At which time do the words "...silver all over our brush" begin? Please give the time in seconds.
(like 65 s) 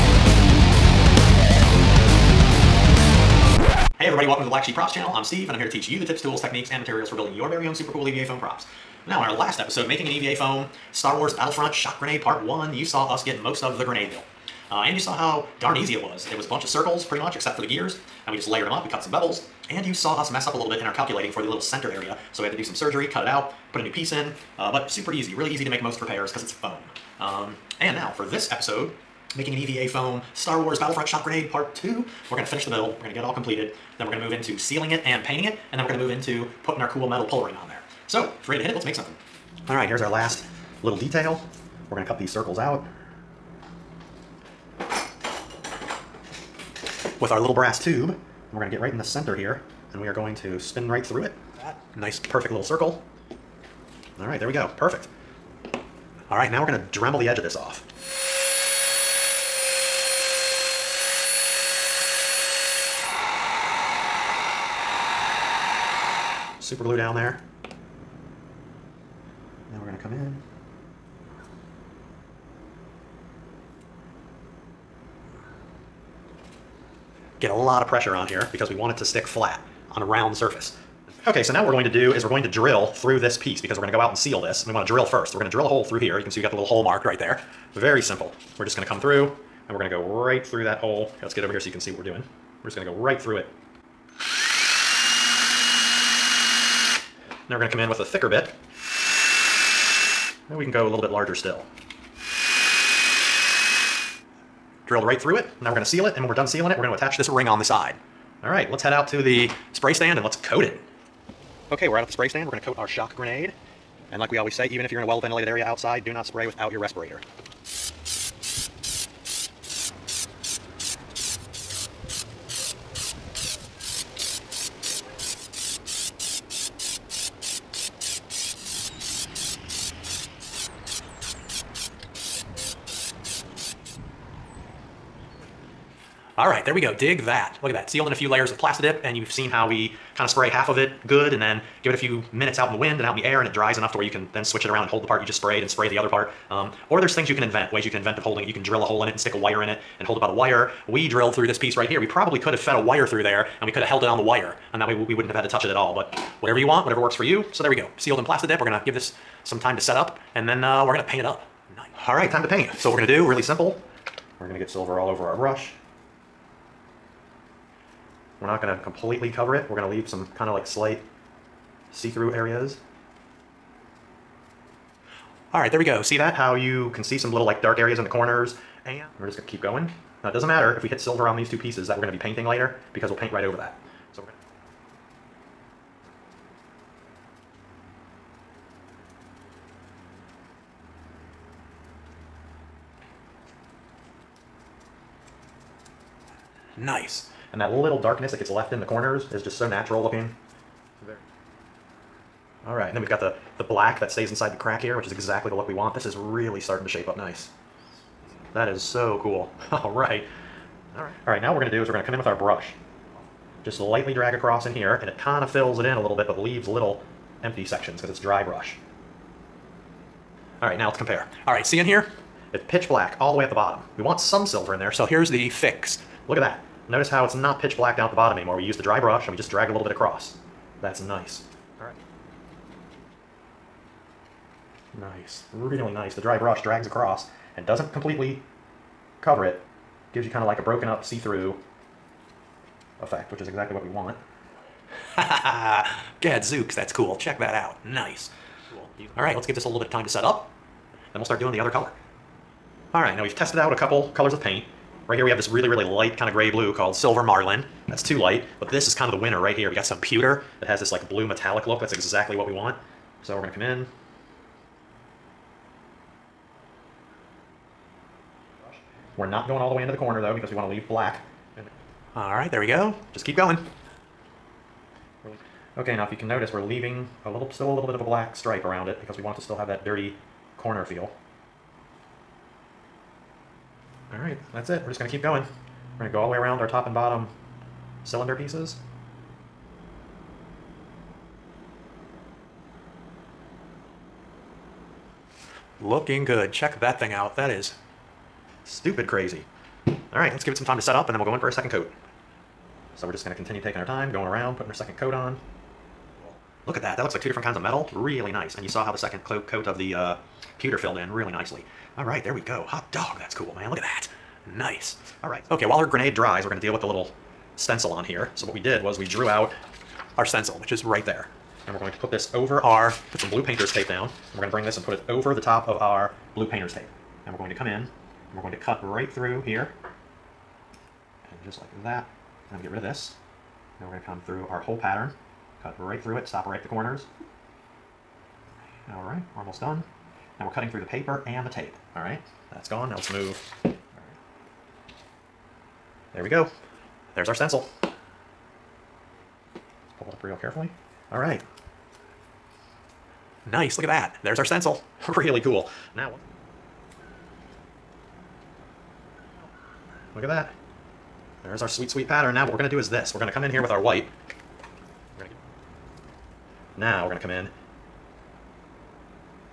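164 s.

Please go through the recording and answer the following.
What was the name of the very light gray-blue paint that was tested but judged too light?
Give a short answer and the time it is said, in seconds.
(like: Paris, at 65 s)
Silver Marlin, at 256 s.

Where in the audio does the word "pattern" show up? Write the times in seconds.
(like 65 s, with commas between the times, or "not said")
334 s, 362 s.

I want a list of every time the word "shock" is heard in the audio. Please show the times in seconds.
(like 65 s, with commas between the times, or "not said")
11 s, 31 s, 112 s.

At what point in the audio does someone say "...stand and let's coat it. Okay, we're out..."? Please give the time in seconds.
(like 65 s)
109 s.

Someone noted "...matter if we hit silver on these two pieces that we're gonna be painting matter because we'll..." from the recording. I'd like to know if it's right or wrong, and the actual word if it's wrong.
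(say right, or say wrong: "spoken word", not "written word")
wrong: "later", not "matter".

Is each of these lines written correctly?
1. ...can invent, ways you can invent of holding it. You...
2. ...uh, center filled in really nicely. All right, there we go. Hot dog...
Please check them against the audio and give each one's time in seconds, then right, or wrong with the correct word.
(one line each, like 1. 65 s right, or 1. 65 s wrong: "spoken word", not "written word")
1. 147 s right
2. 309 s wrong: "pewter", not "center".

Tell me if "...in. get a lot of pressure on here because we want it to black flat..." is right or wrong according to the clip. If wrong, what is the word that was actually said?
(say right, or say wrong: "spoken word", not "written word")
wrong: "stick", not "black".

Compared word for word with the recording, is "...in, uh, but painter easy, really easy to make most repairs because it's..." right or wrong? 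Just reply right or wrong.
wrong.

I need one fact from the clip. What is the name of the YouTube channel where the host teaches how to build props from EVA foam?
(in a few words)
Black Sheep Props.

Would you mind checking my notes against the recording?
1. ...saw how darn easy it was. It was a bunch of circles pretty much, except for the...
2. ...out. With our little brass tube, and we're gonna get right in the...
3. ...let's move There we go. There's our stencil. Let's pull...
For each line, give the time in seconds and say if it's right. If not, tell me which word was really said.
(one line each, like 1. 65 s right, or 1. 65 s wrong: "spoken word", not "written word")
1. 14 s right
2. 42 s right
3. 342 s right.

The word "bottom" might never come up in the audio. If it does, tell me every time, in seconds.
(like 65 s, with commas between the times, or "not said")
223 s, 228 s, 286 s.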